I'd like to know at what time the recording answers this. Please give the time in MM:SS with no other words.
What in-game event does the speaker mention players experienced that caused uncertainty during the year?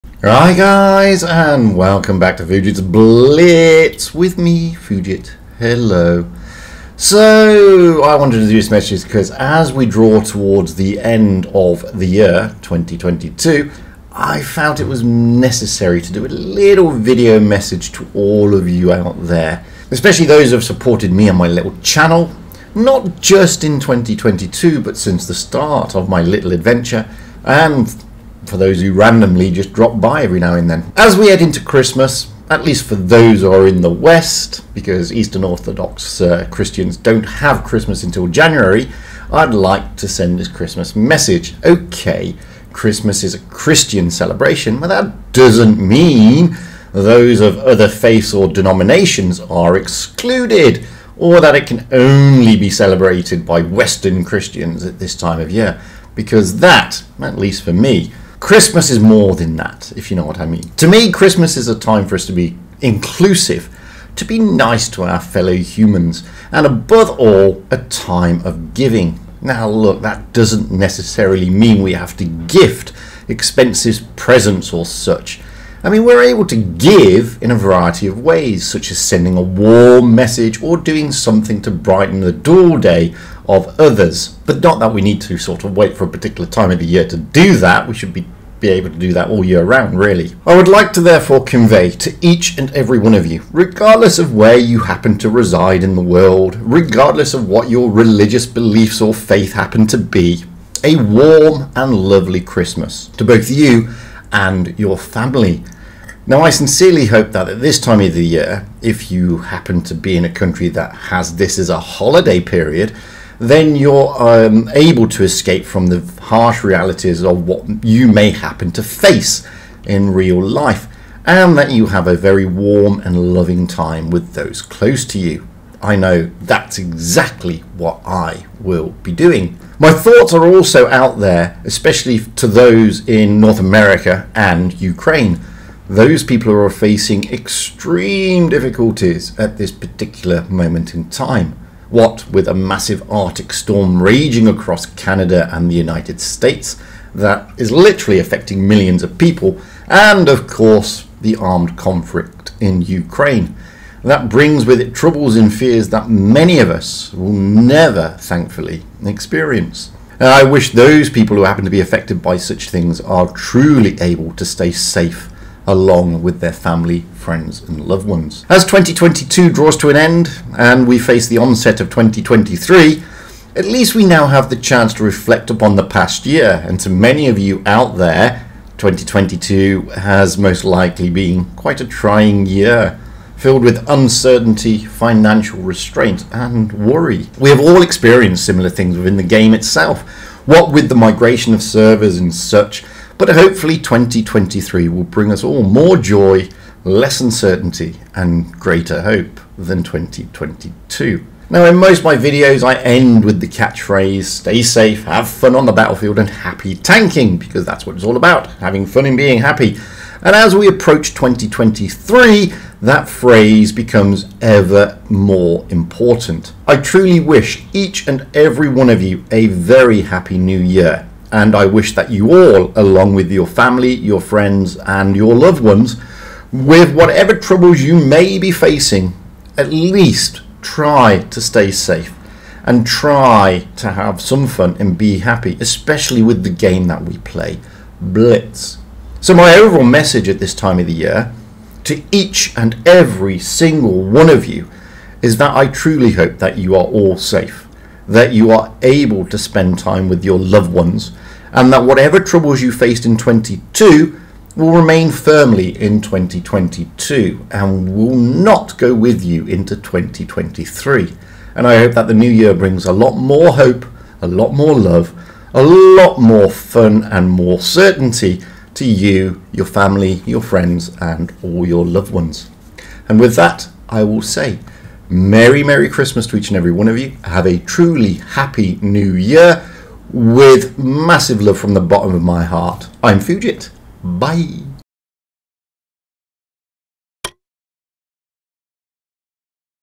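03:10.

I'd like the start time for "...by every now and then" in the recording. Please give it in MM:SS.
00:30.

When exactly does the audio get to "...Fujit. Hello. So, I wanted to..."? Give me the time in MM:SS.
00:04.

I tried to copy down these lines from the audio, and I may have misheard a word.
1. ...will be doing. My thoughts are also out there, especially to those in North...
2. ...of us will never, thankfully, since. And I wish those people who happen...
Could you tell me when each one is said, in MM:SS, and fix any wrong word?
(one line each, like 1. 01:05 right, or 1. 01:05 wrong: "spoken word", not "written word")
1. 02:08 right
2. 02:36 wrong: "experience", not "since".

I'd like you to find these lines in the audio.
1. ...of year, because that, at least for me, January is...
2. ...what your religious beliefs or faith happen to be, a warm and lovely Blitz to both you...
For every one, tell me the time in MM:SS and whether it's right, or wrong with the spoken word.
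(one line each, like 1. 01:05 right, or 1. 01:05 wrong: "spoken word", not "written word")
1. 00:55 wrong: "Christmas", not "January"
2. 01:37 wrong: "Christmas", not "Blitz".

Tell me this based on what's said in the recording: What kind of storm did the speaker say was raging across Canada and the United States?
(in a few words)
Arctic storm.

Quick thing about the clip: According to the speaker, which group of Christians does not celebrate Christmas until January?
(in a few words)
Eastern Orthodox.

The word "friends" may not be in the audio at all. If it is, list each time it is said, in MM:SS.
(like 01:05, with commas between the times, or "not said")
02:47, 03:44, 04:30.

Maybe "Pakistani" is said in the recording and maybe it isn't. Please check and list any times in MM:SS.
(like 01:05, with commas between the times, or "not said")
not said.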